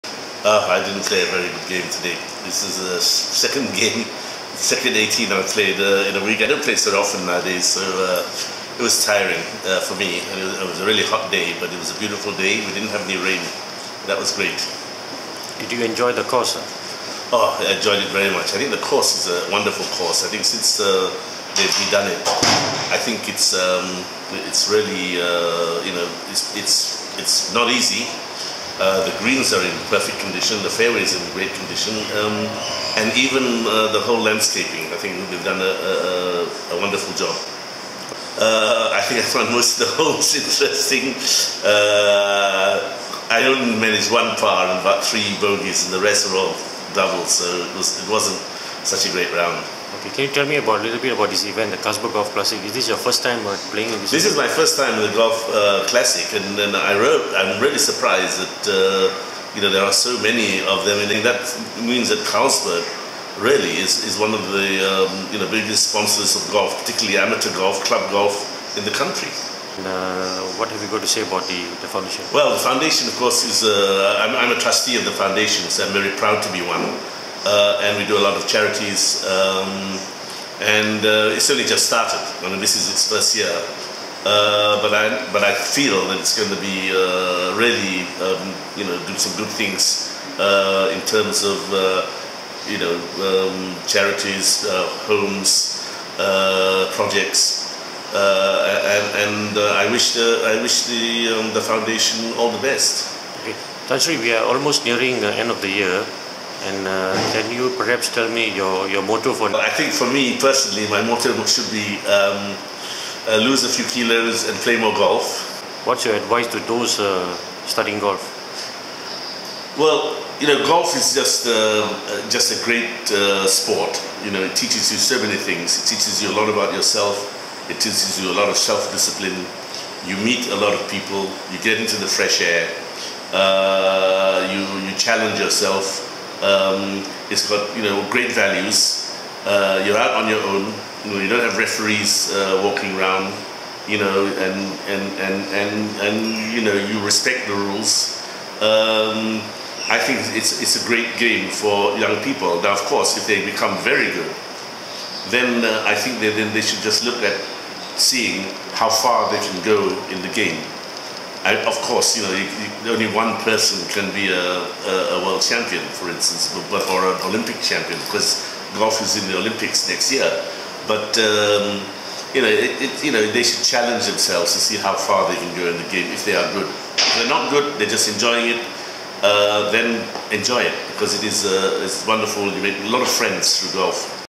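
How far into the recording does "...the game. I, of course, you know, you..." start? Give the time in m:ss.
2:40.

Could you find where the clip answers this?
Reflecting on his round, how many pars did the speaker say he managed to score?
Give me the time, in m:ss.
0:44.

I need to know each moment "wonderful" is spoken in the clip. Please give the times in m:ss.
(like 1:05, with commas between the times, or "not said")
0:19, 0:36, 3:02.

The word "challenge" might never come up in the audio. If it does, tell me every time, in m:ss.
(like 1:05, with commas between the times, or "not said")
2:14, 2:53.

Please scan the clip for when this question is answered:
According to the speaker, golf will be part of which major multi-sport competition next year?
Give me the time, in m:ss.
2:49.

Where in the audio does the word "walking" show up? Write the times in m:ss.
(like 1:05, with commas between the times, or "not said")
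2:22.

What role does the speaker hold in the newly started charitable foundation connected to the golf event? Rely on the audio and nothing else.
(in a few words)
Trustee.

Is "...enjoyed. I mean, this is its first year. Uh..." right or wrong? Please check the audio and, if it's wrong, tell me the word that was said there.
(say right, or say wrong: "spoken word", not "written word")
wrong: "started", not "enjoyed".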